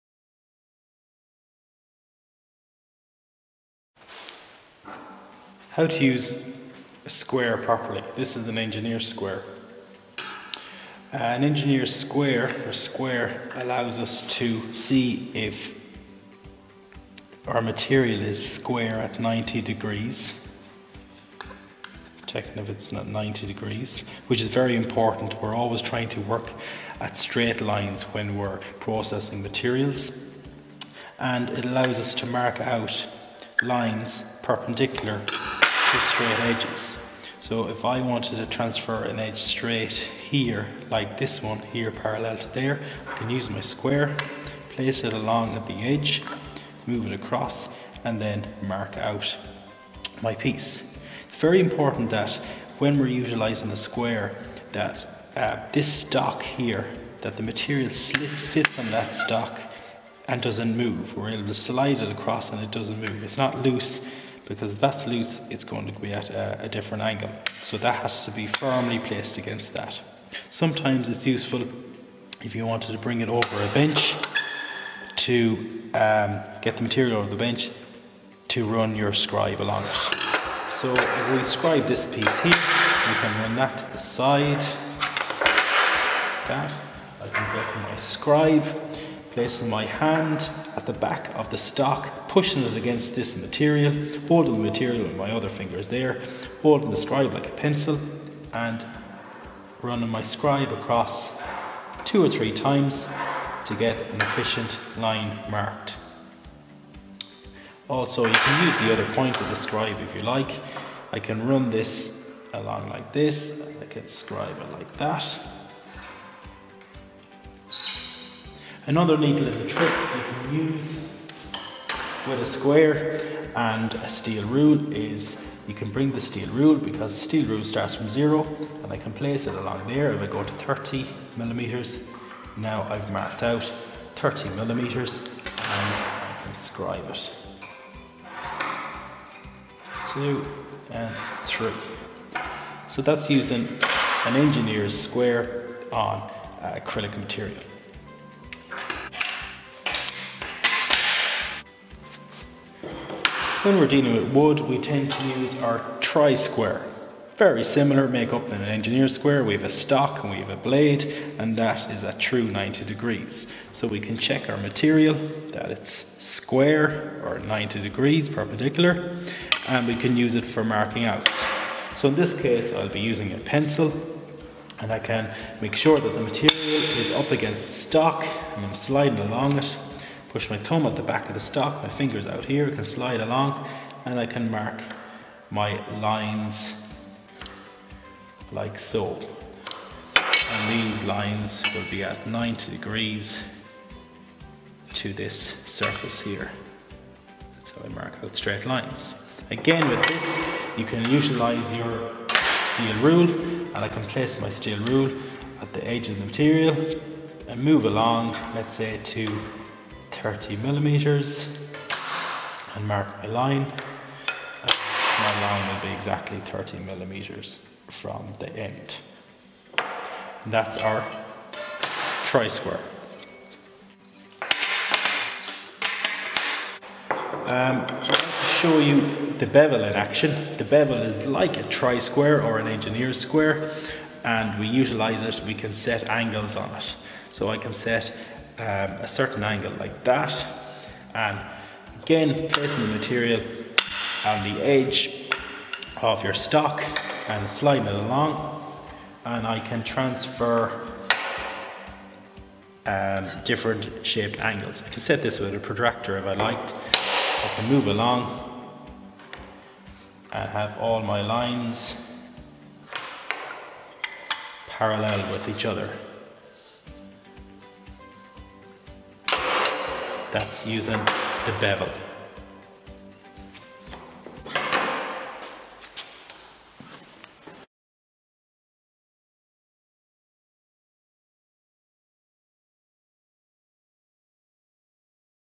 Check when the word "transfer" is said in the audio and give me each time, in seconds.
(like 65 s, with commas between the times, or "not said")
38 s, 249 s.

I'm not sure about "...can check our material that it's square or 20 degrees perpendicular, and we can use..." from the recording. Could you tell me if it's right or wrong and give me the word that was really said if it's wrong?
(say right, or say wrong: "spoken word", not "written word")
wrong: "90", not "20".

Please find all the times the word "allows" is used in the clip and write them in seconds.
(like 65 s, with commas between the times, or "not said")
13 s, 31 s.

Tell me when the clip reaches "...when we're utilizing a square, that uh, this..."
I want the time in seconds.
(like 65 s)
52 s.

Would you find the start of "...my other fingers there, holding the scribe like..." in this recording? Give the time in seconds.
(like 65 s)
95 s.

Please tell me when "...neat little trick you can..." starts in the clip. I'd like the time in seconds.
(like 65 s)
119 s.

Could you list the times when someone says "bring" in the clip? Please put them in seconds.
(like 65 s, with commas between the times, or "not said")
72 s, 125 s.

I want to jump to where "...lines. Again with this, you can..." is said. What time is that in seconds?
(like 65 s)
198 s.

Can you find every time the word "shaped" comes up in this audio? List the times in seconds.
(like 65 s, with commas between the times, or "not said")
254 s.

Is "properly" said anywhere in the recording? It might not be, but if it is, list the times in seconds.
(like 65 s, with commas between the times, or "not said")
7 s.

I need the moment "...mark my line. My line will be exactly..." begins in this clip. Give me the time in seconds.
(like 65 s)
212 s.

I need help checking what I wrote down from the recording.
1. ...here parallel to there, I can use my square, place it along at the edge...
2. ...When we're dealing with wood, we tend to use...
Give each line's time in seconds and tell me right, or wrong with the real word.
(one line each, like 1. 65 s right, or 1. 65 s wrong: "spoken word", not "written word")
1. 41 s right
2. 153 s right.